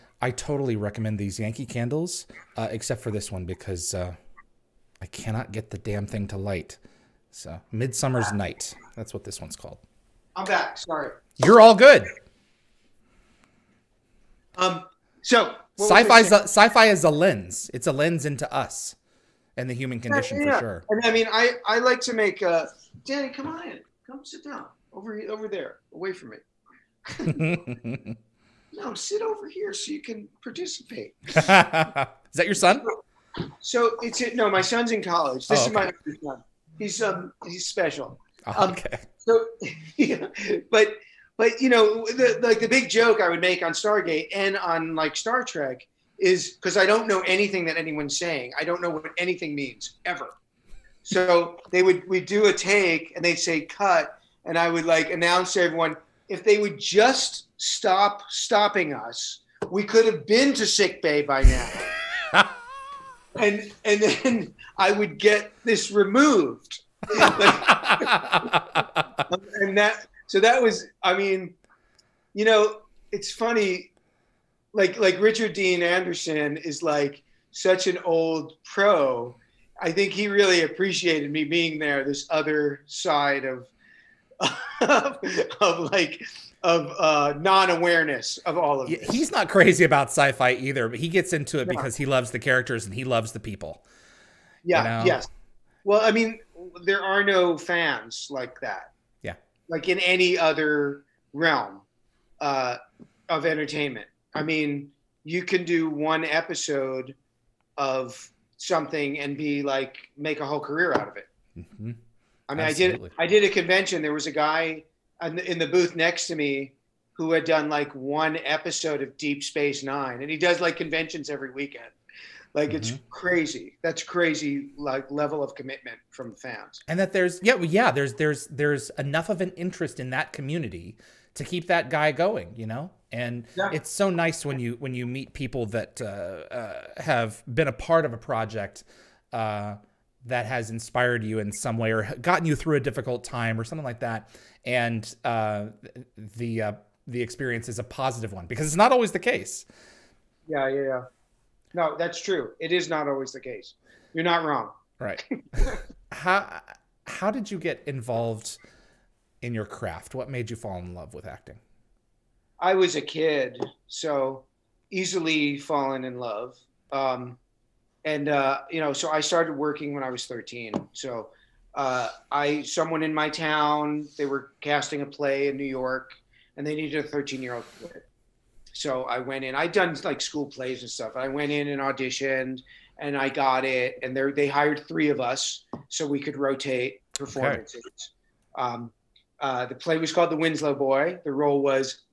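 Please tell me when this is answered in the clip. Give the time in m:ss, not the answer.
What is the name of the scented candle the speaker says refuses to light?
0:07.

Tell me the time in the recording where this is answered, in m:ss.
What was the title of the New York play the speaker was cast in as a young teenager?
3:10.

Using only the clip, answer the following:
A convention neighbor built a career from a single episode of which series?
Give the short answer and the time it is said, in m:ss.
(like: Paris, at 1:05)
Deep Space Nine, at 1:59.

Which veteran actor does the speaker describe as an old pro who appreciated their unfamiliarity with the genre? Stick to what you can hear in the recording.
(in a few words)
Richard Dean Anderson.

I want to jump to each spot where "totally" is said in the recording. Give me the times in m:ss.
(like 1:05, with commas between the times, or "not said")
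0:00.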